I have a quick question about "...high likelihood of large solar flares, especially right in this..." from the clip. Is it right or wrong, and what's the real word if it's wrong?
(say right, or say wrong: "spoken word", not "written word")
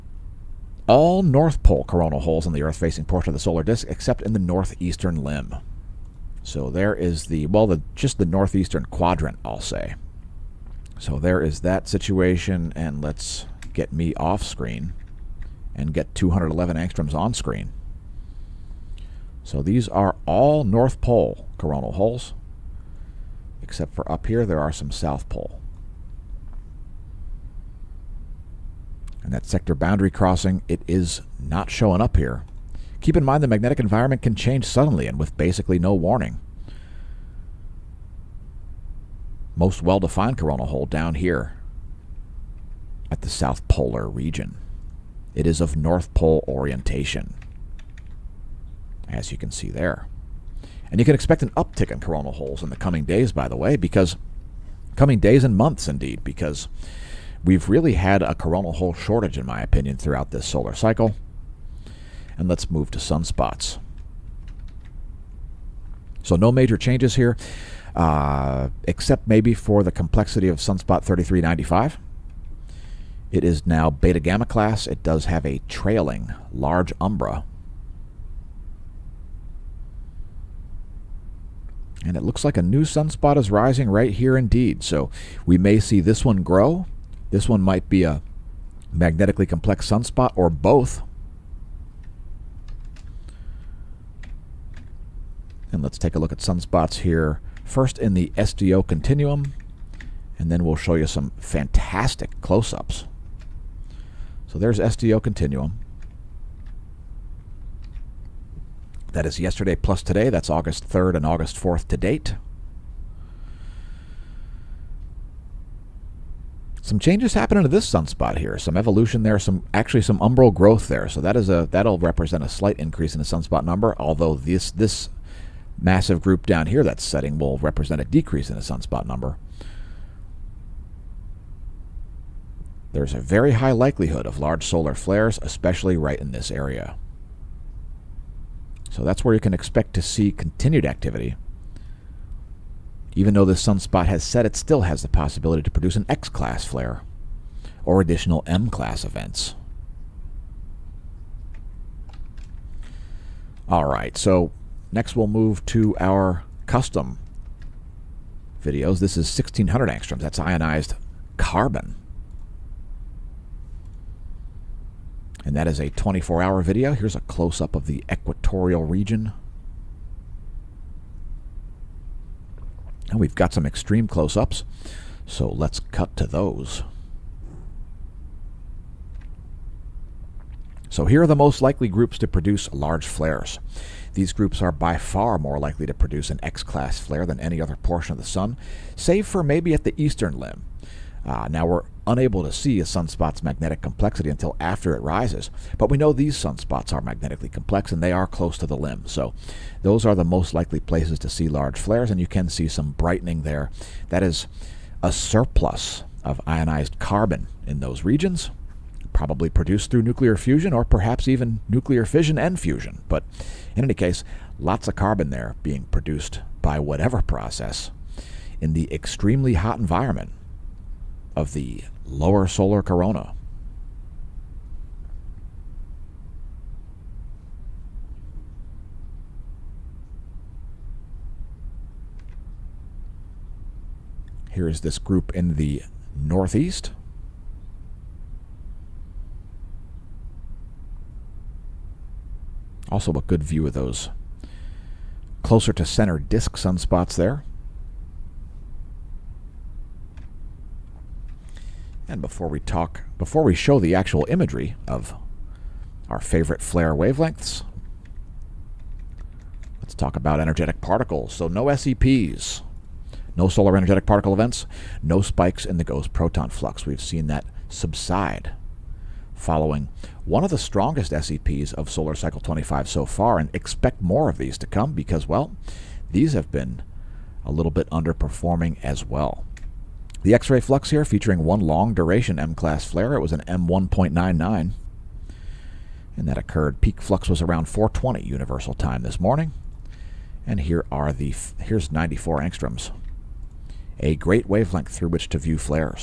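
right.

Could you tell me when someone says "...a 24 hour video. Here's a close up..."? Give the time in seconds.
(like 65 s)
165 s.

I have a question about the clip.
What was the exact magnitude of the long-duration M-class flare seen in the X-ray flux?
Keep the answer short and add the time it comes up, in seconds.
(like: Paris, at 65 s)
M1.99, at 283 s.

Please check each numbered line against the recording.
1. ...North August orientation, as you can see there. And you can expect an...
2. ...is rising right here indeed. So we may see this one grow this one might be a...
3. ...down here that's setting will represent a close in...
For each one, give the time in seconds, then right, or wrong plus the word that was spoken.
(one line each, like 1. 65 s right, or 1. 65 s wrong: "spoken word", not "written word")
1. 45 s wrong: "Pole", not "August"
2. 83 s right
3. 126 s wrong: "decrease", not "close".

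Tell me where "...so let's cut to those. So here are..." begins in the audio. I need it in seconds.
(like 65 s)
175 s.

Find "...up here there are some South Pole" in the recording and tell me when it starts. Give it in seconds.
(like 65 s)
24 s.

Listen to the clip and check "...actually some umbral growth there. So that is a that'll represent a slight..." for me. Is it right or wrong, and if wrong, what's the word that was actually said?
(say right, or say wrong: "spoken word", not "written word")
right.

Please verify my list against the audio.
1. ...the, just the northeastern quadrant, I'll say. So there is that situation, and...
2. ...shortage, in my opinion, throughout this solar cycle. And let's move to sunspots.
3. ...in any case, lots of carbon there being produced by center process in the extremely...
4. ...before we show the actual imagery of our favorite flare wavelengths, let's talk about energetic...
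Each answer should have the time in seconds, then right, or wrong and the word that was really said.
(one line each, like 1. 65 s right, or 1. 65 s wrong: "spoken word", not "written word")
1. 7 s right
2. 58 s right
3. 213 s wrong: "whatever", not "center"
4. 253 s right.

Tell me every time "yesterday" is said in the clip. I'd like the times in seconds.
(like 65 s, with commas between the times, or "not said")
109 s.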